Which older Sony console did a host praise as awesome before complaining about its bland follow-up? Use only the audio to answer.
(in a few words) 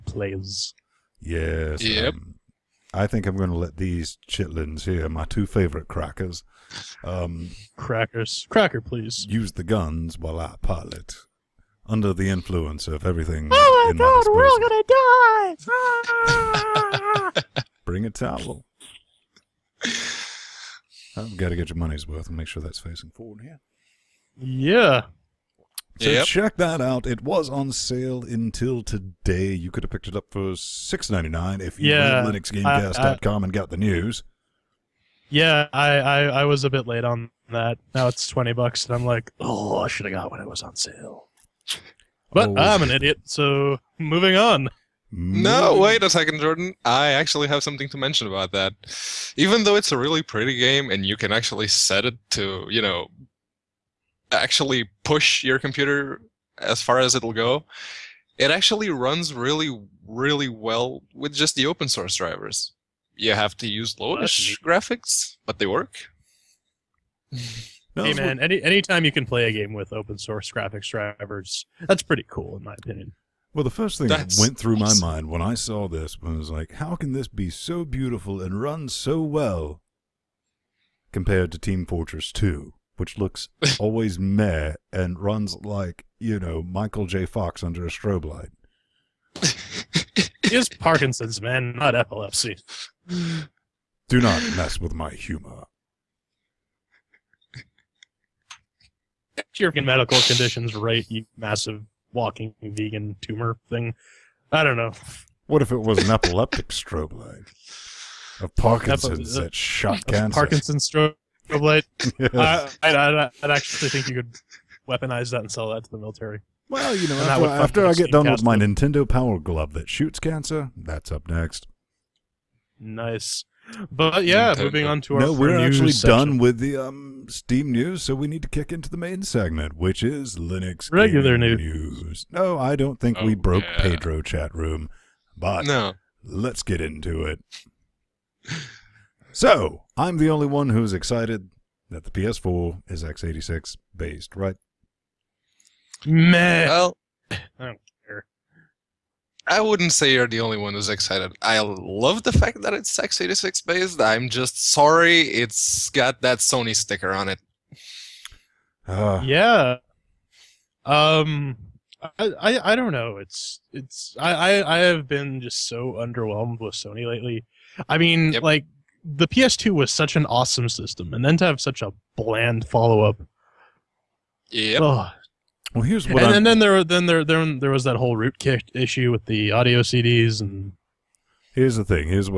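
PS2.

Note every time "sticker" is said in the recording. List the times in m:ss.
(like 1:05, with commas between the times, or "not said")
2:36.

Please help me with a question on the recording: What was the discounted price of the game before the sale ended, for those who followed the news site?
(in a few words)
$6.99.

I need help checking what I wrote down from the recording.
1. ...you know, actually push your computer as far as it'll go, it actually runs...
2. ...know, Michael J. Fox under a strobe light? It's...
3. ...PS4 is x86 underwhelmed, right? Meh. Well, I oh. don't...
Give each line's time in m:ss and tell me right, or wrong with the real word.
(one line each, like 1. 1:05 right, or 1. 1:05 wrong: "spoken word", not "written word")
1. 0:52 right
2. 1:26 right
3. 2:22 wrong: "based", not "underwhelmed".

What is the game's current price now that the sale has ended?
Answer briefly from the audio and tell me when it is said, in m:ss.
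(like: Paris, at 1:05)
20 dollars, at 0:38.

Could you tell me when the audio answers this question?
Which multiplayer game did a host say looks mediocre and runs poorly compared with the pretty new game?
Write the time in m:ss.
1:21.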